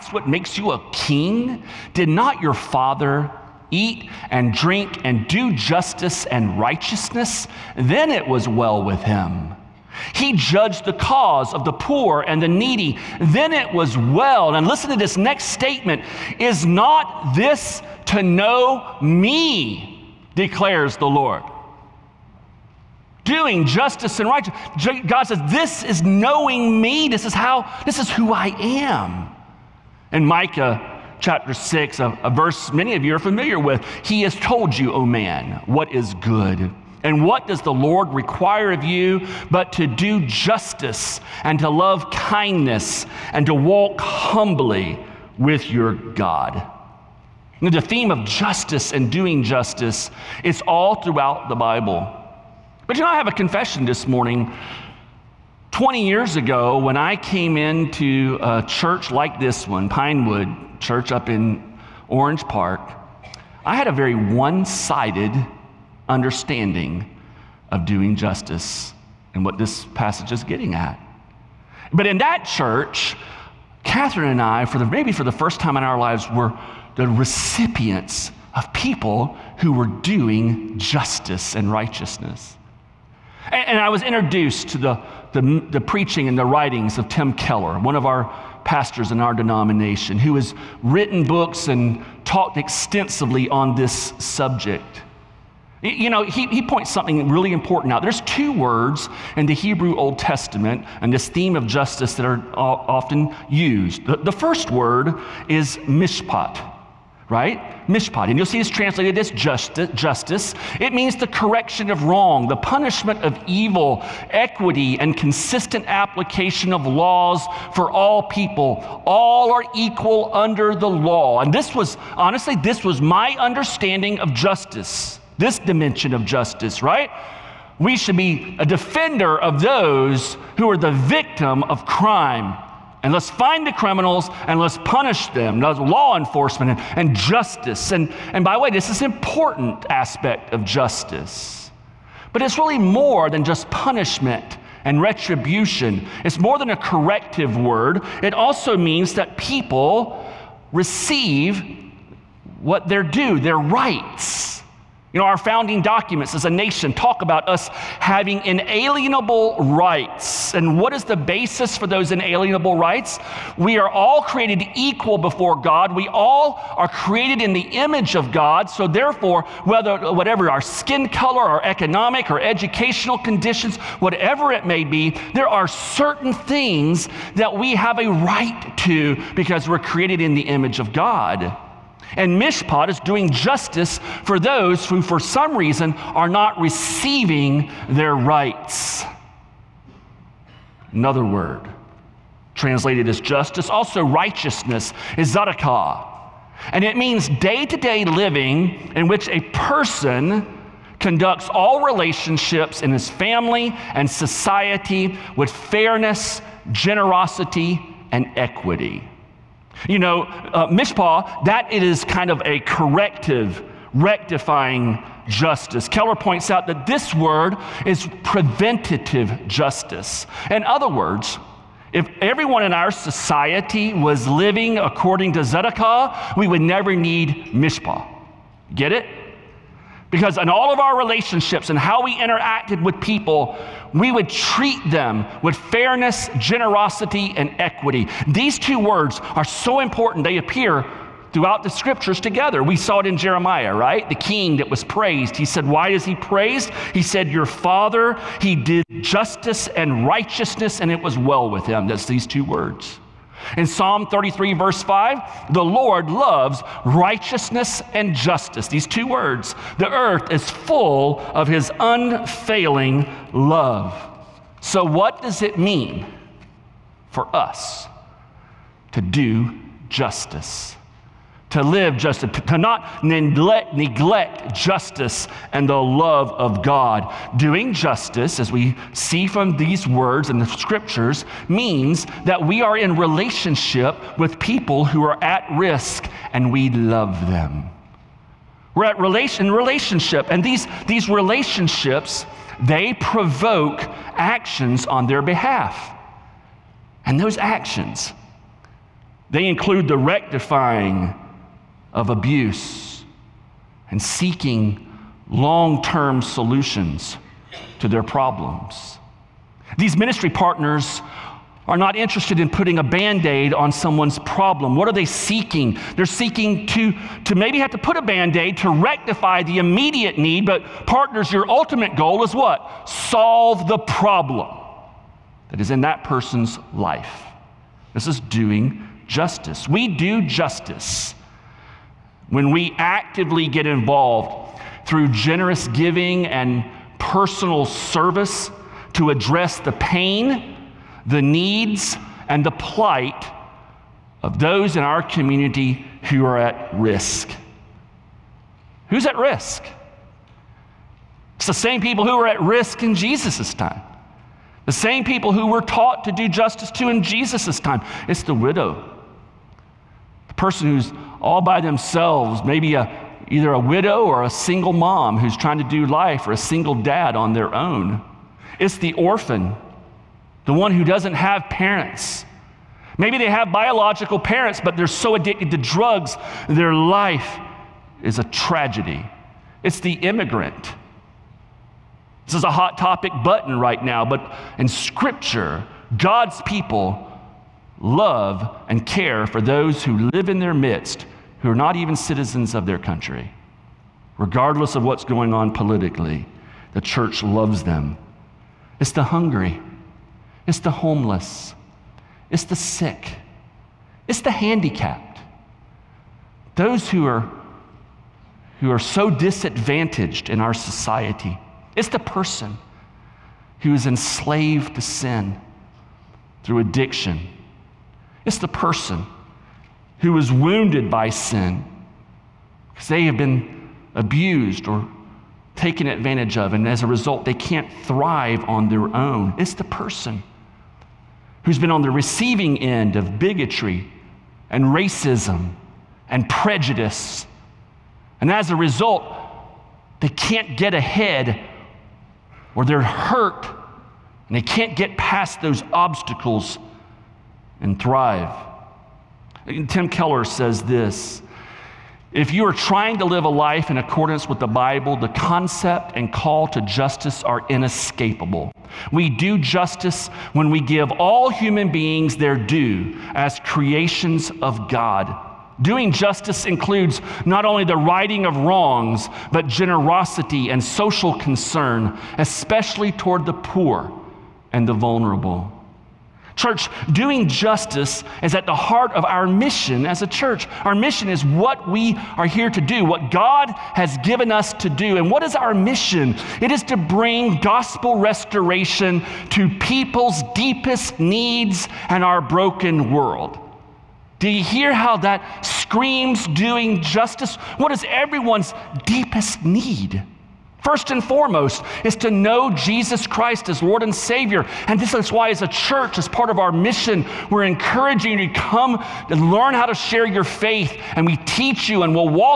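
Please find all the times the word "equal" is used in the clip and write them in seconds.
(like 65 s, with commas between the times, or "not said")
119 s, 164 s.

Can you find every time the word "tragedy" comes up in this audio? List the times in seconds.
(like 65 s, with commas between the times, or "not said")
378 s.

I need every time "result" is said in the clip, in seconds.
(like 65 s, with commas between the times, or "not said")
426 s, 438 s.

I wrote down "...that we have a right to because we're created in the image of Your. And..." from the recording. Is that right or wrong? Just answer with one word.
wrong.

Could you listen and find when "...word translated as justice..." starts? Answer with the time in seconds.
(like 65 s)
191 s.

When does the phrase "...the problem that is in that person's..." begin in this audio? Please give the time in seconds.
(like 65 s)
323 s.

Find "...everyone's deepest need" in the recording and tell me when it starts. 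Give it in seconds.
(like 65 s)
497 s.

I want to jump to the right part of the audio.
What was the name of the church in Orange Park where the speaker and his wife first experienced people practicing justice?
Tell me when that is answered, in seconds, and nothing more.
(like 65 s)
59 s.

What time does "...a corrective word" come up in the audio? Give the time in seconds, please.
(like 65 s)
146 s.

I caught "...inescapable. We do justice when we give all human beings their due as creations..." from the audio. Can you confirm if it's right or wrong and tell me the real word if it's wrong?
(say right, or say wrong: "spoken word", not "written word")
right.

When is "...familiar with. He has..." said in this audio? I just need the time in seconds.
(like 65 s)
33 s.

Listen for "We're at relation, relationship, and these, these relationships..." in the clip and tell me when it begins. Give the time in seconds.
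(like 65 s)
288 s.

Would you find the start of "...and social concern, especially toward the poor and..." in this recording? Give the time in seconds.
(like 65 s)
470 s.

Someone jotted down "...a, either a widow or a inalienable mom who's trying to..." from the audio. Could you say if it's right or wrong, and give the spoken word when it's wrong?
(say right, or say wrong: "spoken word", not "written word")
wrong: "single", not "inalienable".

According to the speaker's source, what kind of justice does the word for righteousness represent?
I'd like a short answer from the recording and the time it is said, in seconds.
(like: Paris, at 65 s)
preventative justice, at 218 s.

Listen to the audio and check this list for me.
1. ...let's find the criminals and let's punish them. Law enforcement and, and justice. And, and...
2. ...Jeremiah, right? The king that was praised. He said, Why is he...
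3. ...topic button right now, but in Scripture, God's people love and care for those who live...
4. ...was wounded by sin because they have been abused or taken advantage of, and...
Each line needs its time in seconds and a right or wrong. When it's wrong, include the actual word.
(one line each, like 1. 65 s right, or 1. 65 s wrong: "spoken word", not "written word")
1. 133 s right
2. 243 s right
3. 382 s right
4. 420 s right.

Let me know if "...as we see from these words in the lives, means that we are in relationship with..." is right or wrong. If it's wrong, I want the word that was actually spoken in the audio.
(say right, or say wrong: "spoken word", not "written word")
wrong: "scriptures", not "lives".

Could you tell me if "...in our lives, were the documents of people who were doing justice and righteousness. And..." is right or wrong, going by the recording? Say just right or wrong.
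wrong.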